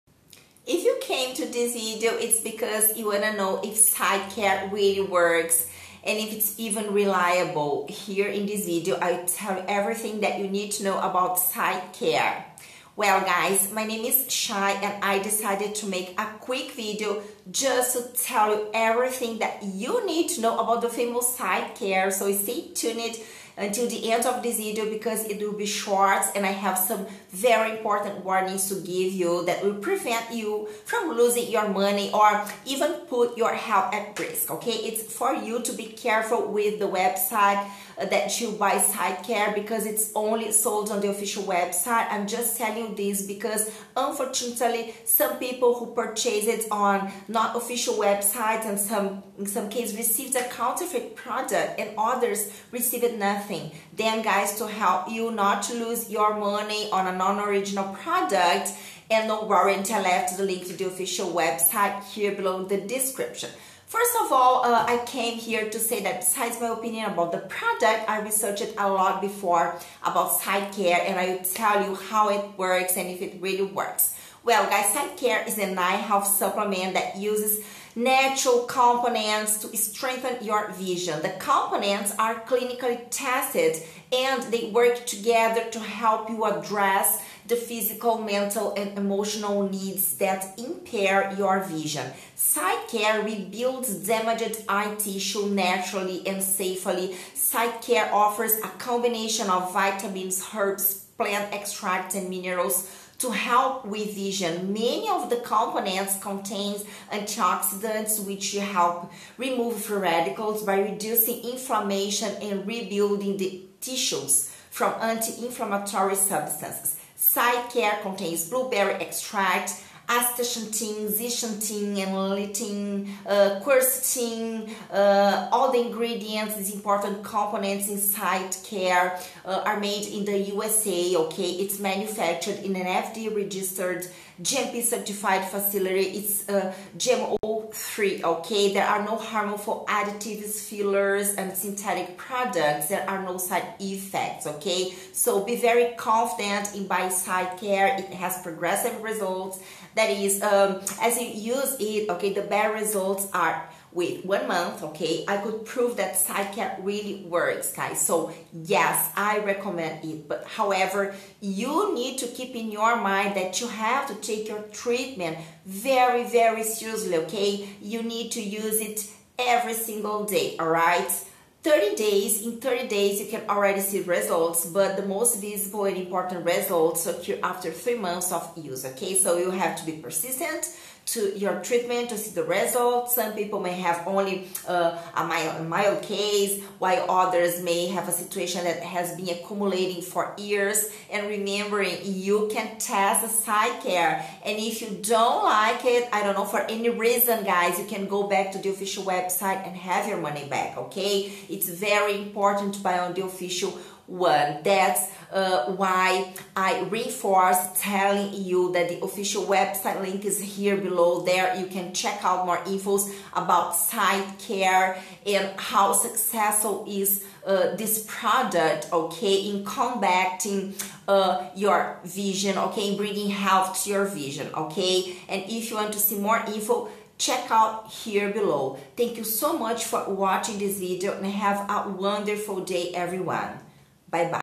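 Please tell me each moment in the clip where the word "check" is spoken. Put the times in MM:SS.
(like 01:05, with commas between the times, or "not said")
03:31, 03:47.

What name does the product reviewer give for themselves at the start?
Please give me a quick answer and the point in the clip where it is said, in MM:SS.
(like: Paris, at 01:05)
Shai, at 00:14.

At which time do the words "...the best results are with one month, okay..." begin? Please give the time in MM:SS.
02:32.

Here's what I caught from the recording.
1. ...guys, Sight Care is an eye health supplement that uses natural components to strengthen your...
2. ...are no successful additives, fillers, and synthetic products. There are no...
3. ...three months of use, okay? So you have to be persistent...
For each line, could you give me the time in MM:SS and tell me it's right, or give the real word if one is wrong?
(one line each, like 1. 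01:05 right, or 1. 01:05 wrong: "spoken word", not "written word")
1. 01:14 right
2. 02:18 wrong: "harmful", not "successful"
3. 02:57 right.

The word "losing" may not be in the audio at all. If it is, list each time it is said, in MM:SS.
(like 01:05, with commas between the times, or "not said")
00:31.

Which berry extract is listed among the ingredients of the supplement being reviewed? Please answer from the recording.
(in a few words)
Blueberry.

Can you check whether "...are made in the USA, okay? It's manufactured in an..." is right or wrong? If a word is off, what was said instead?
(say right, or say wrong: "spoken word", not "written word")
right.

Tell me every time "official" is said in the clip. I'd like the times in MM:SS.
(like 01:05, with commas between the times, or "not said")
00:41, 00:47, 01:00, 03:18, 03:23, 03:29.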